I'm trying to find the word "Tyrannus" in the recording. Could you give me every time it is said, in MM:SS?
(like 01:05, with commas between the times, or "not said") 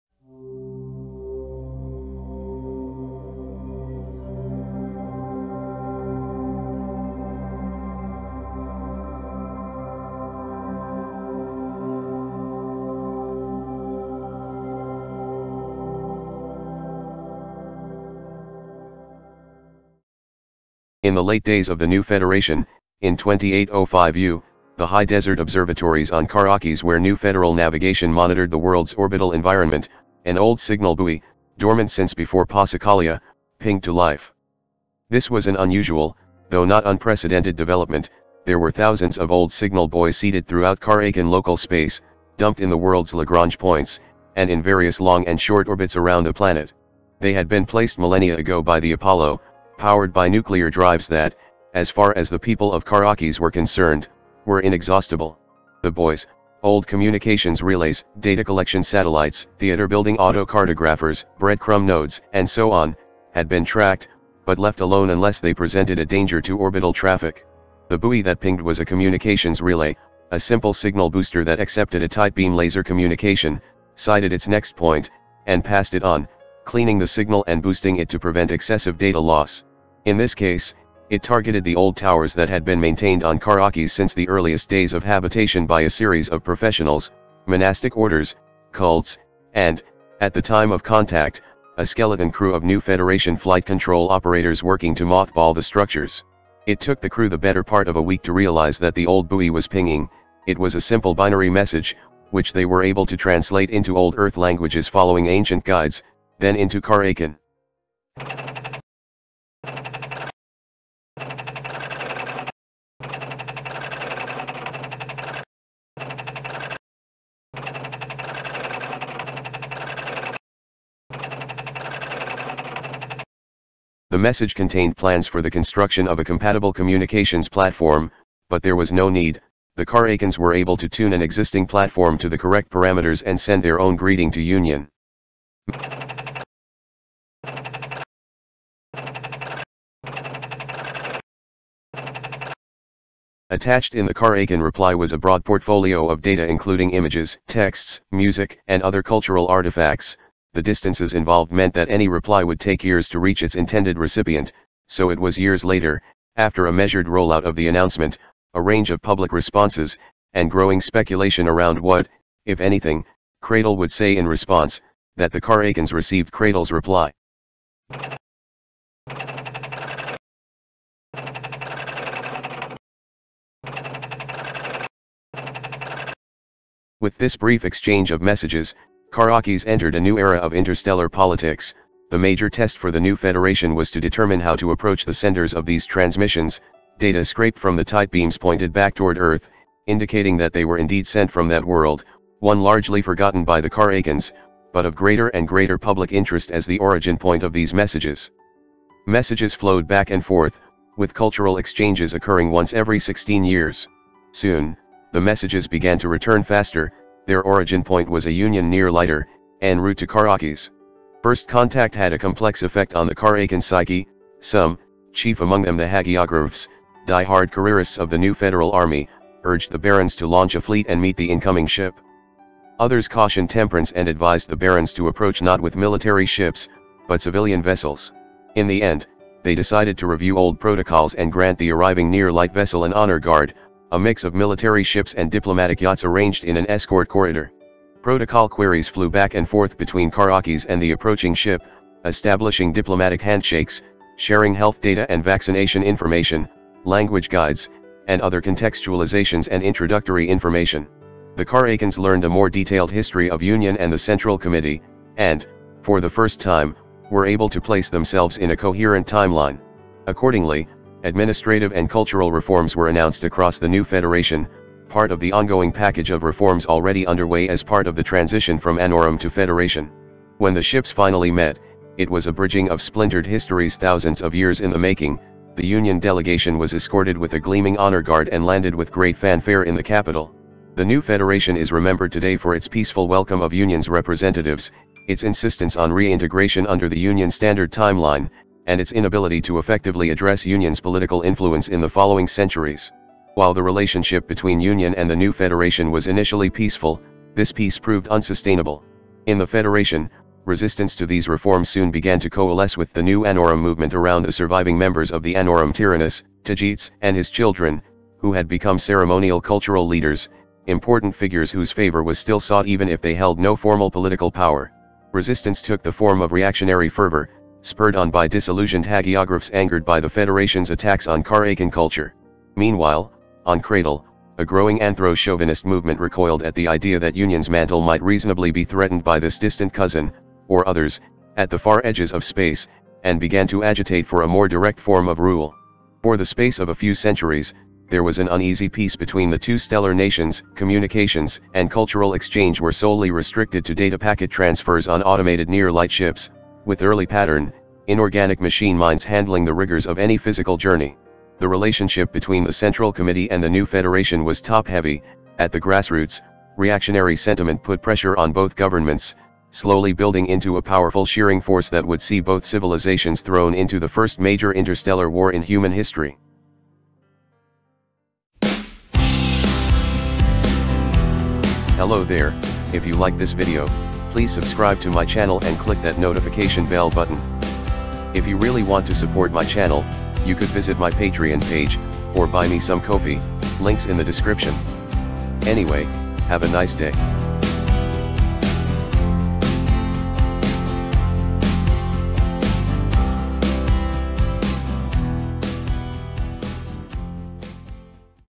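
05:05.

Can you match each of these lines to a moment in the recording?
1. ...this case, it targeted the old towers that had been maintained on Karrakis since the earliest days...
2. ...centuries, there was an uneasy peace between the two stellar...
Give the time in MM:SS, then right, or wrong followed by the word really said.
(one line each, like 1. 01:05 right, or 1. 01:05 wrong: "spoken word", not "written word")
1. 01:20 right
2. 05:36 right.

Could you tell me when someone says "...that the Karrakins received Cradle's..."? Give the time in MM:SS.
02:45.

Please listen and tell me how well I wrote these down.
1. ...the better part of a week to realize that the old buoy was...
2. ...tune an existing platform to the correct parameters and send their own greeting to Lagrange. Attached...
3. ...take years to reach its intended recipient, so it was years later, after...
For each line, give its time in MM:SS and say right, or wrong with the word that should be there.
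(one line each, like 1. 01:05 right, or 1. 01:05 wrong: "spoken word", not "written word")
1. 01:37 right
2. 02:10 wrong: "Union", not "Lagrange"
3. 02:32 right.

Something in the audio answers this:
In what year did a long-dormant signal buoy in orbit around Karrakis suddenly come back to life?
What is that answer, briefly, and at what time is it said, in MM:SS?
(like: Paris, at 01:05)
2805, at 00:23.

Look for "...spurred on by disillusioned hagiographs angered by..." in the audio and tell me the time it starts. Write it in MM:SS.
05:17.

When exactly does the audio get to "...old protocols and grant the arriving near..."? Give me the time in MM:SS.
03:50.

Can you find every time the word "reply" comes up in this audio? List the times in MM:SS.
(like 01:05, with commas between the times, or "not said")
02:24, 02:32, 02:46.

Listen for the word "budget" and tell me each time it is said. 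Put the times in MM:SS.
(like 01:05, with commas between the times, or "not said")
not said.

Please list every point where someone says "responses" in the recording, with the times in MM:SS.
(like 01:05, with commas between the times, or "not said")
02:39, 02:44.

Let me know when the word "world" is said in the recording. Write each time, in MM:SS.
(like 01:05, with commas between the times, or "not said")
00:28, 00:42, 03:11.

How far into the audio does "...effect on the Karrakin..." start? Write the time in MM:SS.
03:32.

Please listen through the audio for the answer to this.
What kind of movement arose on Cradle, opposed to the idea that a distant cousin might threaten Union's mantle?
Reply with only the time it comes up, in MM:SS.
05:24.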